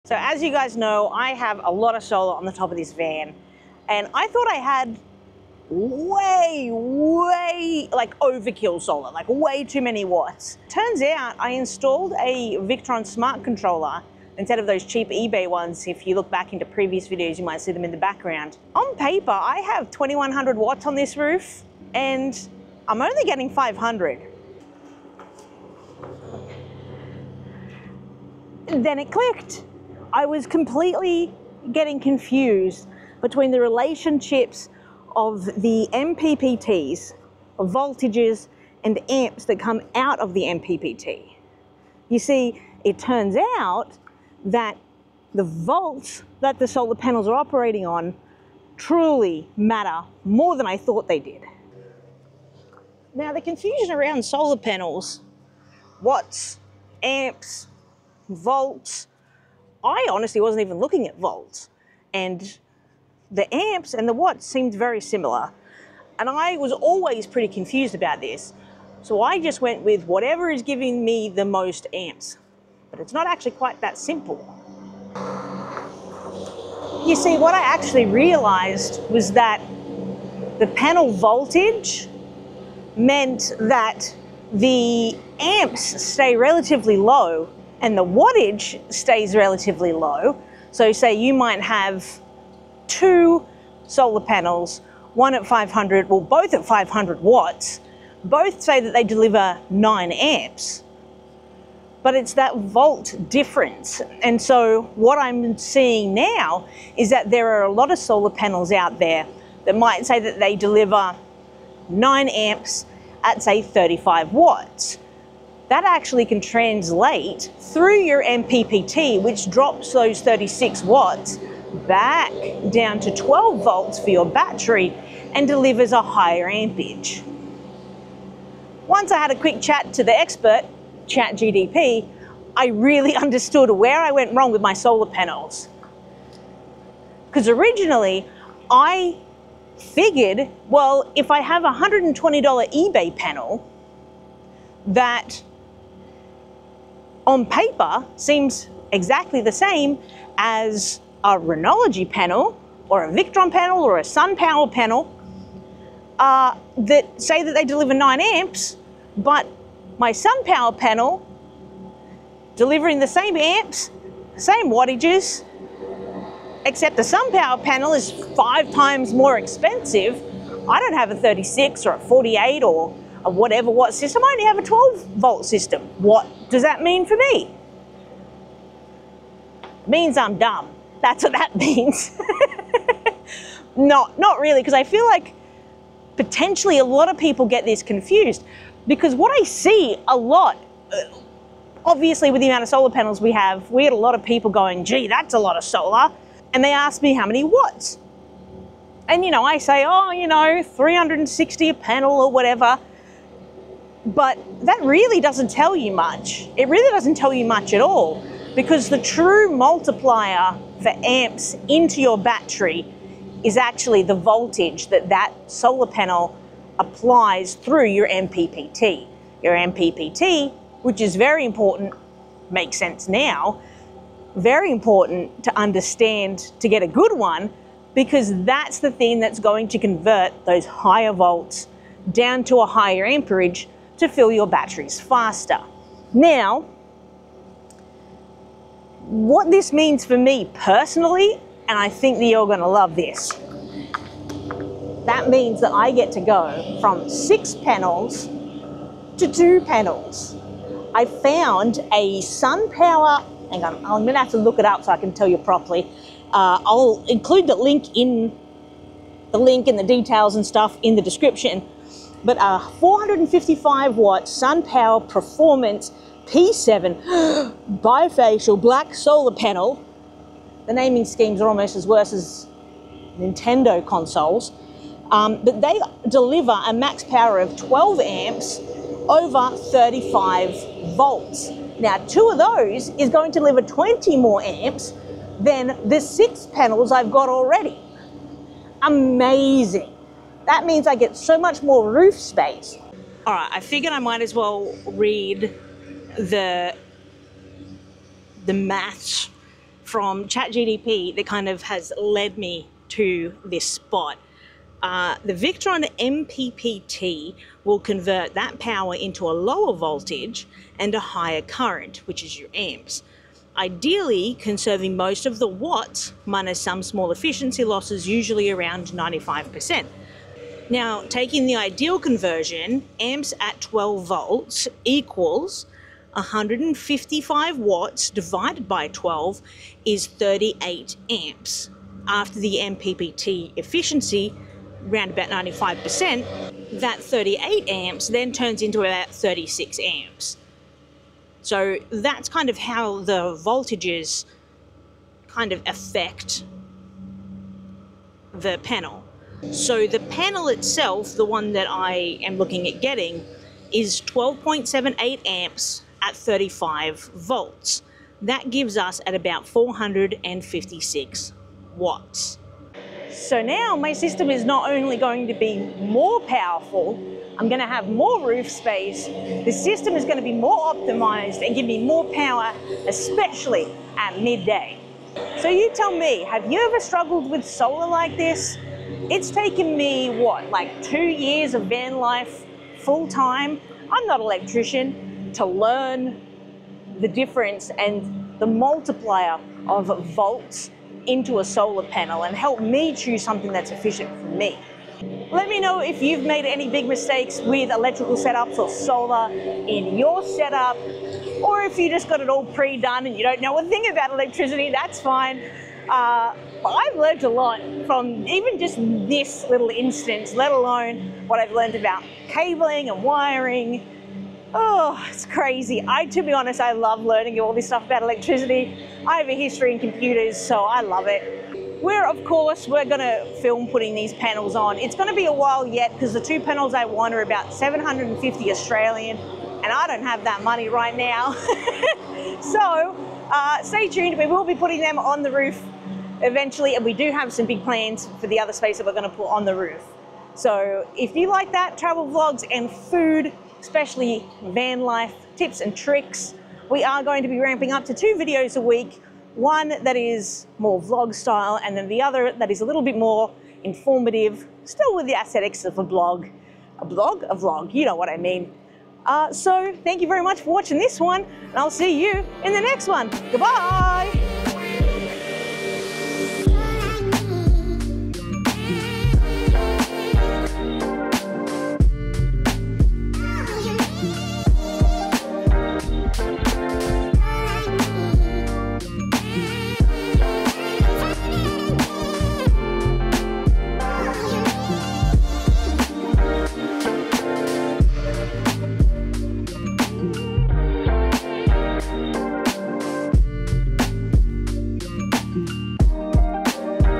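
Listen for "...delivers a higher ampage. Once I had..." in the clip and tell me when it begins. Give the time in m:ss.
2:05.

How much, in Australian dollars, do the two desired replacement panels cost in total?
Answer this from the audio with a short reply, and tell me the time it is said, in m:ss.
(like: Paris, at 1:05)
750, at 7:07.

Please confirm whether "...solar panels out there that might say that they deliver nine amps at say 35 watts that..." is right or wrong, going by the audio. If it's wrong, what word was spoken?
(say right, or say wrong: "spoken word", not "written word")
right.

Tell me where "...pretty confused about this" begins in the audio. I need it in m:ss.
1:07.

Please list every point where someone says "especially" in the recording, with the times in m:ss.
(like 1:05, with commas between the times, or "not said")
6:12, 7:23.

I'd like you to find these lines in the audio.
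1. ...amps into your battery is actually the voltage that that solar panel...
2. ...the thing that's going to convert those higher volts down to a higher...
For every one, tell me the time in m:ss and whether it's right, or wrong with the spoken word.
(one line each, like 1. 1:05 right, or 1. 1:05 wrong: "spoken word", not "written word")
1. 3:31 right
2. 3:48 right.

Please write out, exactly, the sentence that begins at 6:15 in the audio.
So you tell me, have you ever struggled with solar like this?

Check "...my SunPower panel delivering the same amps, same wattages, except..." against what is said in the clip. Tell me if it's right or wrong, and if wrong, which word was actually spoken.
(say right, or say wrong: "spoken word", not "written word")
right.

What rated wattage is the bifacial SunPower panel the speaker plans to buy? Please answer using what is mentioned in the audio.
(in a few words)
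455 watts.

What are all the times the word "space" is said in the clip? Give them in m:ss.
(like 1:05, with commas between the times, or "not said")
4:52, 6:08, 7:18.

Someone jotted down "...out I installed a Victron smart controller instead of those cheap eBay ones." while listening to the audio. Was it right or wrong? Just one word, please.
right.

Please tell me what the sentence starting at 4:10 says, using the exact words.
I found a SunPower, hang on, I'm gonna have to look it up so I can tell you properly.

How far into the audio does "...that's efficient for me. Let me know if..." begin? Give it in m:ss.
6:33.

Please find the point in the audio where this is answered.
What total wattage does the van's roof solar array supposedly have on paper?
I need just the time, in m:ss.
0:19.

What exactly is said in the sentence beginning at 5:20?
Now, taking the ideal conversion, amps at 12 volts equals 155 watts divided by 12 is 38 amps.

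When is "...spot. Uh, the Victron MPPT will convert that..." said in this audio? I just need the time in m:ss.
5:03.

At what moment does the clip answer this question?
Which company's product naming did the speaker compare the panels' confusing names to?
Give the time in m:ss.
4:33.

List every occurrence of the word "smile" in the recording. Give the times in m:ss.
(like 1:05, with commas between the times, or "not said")
not said.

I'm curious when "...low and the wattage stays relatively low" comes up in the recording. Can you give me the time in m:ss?
1:26.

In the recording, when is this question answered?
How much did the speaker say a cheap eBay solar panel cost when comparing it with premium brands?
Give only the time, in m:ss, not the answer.
2:21.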